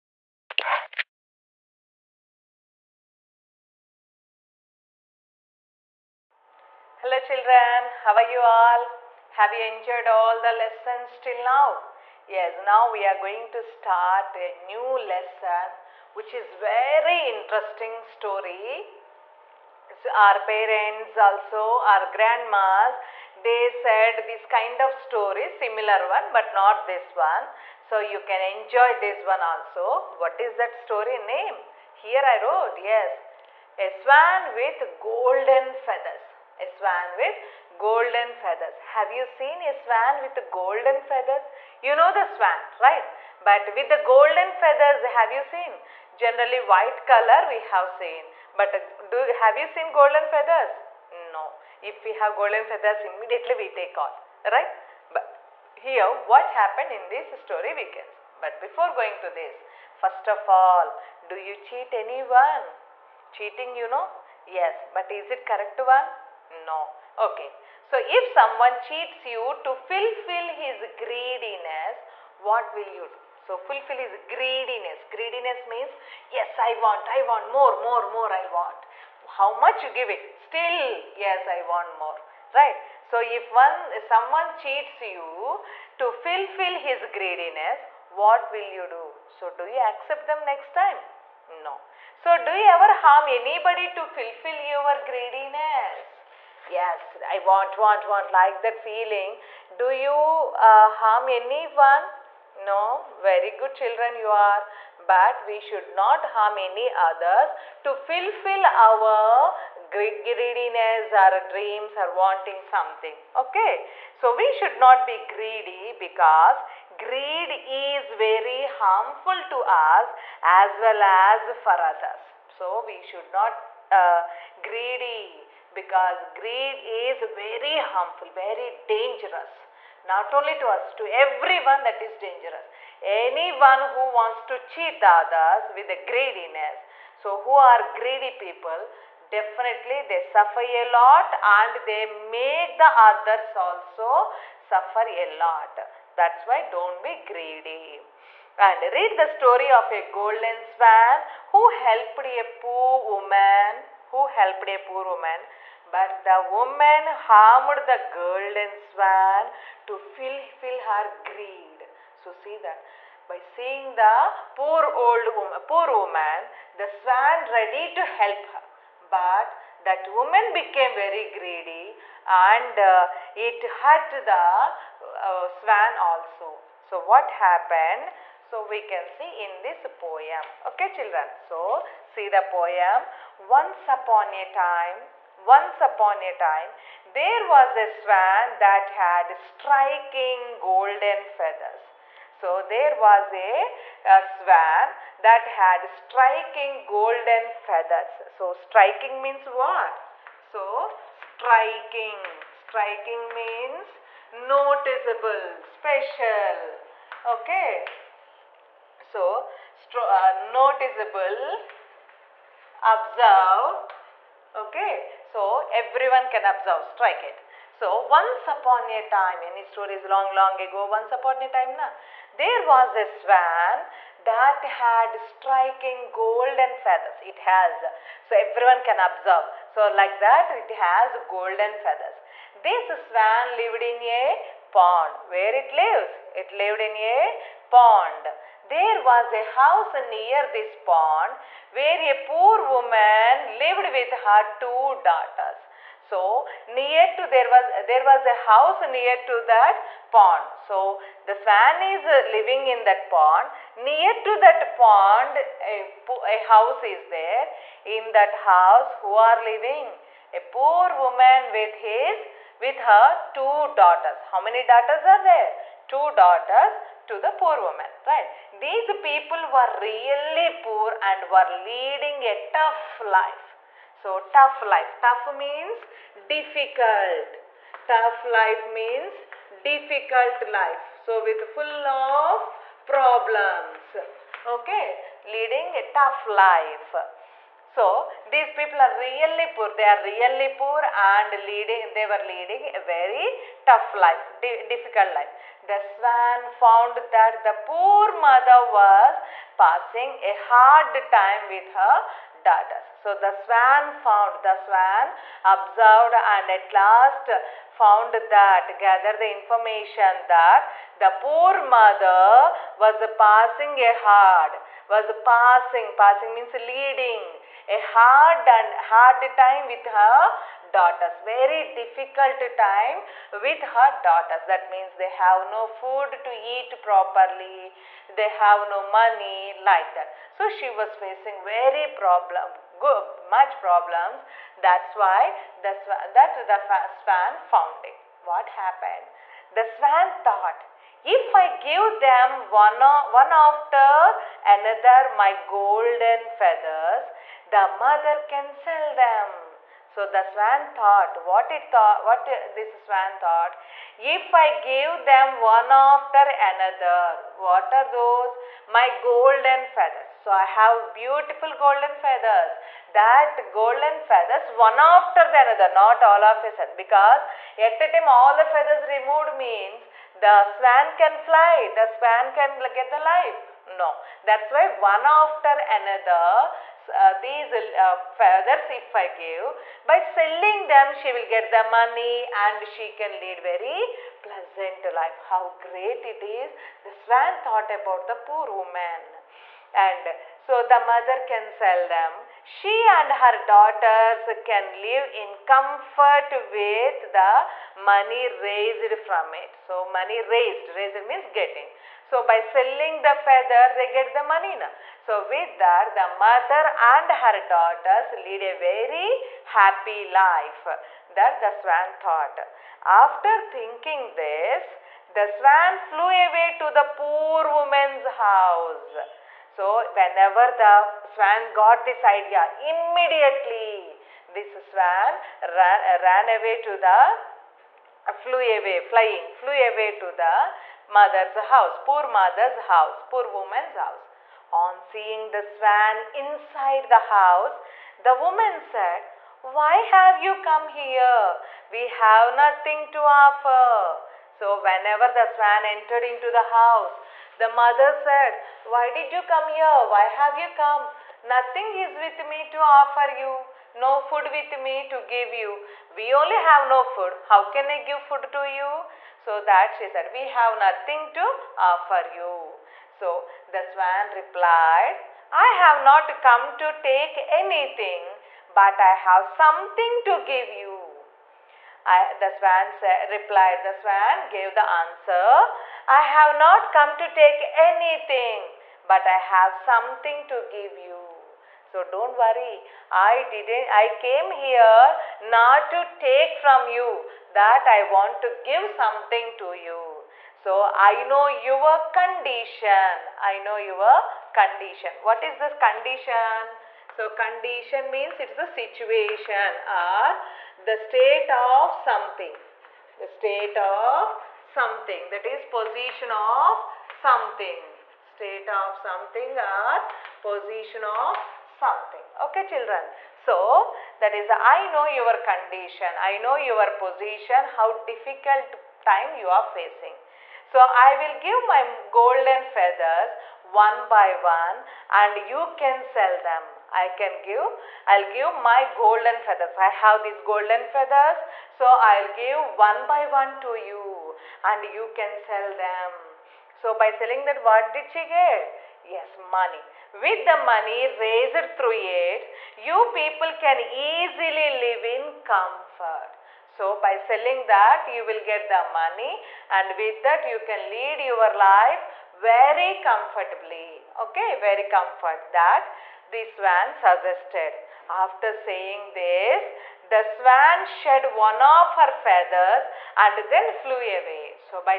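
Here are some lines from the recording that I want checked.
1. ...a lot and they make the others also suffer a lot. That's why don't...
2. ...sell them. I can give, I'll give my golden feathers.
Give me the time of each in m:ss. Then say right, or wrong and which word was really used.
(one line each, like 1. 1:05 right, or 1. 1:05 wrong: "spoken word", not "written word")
1. 2:20 right
2. 8:45 right.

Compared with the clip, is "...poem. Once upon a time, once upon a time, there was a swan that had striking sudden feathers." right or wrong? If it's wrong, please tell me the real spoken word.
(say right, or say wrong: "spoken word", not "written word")
wrong: "golden", not "sudden".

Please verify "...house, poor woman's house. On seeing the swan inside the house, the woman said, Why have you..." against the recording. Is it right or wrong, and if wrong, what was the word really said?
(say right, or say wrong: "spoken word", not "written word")
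right.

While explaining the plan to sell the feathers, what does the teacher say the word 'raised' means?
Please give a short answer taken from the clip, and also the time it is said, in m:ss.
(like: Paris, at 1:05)
getting, at 6:40.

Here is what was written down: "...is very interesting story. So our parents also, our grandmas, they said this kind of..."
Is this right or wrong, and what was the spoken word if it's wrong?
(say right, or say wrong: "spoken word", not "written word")
right.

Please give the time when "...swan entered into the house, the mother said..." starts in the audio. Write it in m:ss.
7:25.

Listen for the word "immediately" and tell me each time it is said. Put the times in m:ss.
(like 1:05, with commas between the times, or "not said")
0:53, 7:02.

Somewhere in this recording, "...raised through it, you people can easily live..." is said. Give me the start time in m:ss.
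9:00.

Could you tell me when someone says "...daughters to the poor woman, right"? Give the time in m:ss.
4:26.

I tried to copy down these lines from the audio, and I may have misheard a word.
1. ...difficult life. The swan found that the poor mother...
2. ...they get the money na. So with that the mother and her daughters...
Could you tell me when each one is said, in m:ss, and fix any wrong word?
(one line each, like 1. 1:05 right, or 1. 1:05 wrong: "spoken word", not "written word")
1. 4:54 right
2. 6:43 right.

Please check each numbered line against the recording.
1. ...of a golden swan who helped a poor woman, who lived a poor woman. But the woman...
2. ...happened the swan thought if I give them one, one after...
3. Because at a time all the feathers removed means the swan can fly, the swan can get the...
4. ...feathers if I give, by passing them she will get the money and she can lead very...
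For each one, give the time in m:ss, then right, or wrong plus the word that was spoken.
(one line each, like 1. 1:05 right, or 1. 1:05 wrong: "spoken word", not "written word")
1. 2:29 wrong: "helped", not "lived"
2. 5:38 right
3. 6:06 right
4. 6:18 wrong: "selling", not "passing".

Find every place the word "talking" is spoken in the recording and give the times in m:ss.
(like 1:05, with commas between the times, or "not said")
not said.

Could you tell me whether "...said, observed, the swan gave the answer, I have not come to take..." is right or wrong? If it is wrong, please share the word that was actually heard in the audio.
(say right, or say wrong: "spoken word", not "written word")
wrong: "replied", not "observed".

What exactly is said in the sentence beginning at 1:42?
No, very good children you are, but we should not harm any others to fulfill our greediness, our dreams, or wanting something.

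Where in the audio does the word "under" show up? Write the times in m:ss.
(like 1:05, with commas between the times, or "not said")
not said.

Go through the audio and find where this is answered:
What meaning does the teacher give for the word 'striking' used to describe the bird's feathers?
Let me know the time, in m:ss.
3:22.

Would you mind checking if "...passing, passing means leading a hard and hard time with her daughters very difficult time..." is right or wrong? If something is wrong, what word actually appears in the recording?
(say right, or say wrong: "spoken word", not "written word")
right.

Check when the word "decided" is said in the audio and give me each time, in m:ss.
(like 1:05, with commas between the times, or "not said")
not said.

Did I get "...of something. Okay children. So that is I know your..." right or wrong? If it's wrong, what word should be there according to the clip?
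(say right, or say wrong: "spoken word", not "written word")
right.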